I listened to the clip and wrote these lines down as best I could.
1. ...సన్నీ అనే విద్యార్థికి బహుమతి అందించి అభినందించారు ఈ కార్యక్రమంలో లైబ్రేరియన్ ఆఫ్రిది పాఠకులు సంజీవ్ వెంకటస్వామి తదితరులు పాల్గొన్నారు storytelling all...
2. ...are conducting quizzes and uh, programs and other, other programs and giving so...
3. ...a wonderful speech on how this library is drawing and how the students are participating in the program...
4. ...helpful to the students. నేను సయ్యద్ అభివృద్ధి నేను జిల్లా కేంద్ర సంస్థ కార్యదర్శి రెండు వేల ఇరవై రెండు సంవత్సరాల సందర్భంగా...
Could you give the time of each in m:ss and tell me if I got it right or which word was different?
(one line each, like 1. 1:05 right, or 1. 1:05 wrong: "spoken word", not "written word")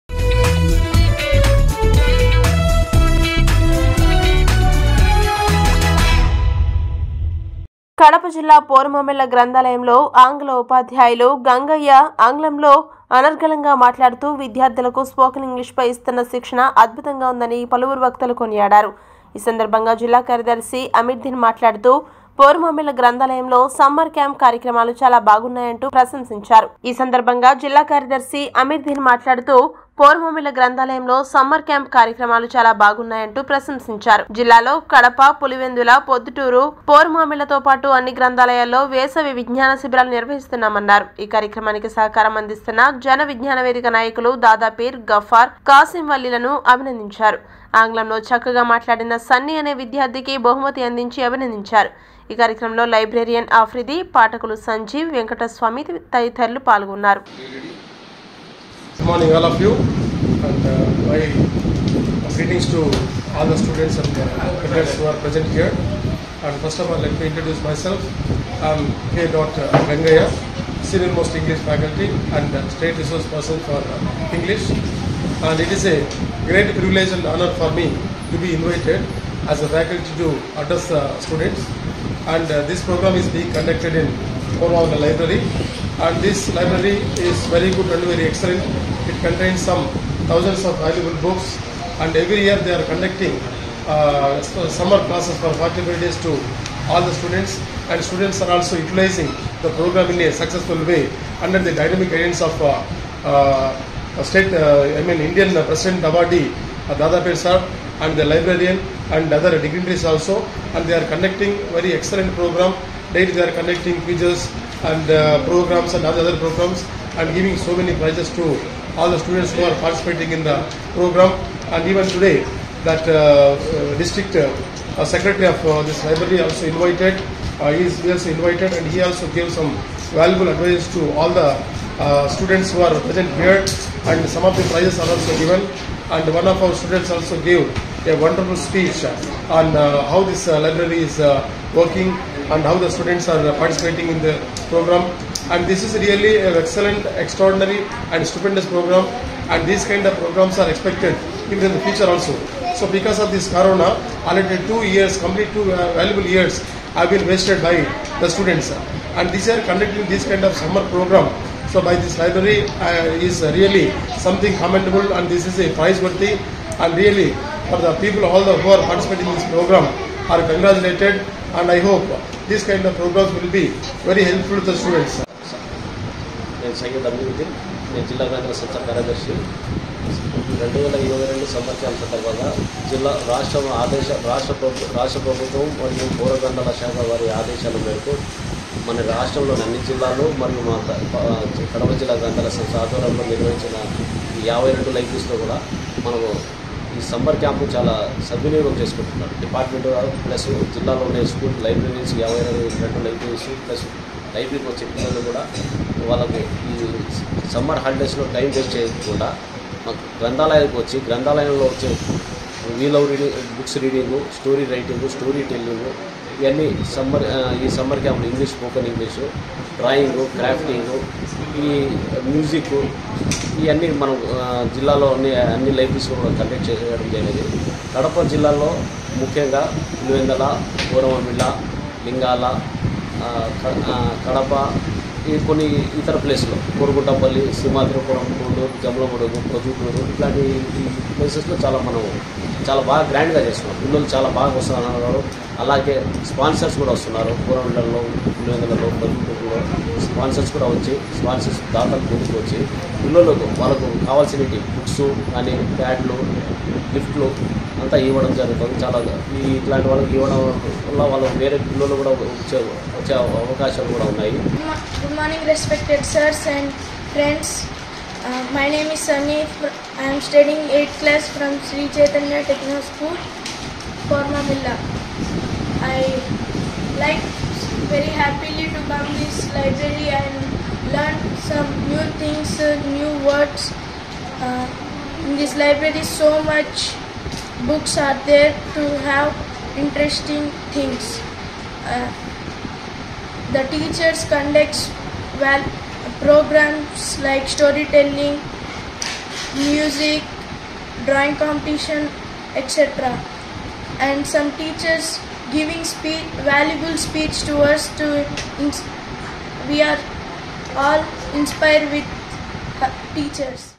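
1. 0:49 wrong: "morning", not "storytelling"
2. 1:53 right
3. 2:18 wrong: "working", not "drawing"
4. 2:54 right.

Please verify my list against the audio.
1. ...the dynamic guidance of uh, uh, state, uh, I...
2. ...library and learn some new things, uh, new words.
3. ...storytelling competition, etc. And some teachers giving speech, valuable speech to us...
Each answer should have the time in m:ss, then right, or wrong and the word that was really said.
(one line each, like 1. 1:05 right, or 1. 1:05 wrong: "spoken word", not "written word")
1. 1:41 right
2. 4:39 right
3. 5:01 wrong: "drawing", not "storytelling".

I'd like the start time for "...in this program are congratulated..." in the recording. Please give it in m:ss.
2:49.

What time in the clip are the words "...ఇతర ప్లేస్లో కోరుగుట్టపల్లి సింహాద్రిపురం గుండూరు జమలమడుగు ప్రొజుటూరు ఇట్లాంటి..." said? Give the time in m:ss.
3:56.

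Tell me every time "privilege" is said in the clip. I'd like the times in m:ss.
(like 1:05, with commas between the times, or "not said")
1:16.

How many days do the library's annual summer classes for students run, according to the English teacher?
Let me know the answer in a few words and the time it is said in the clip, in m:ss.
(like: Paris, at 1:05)
45, at 1:35.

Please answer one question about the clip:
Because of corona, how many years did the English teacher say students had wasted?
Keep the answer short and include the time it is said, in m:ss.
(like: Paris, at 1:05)
2, at 2:35.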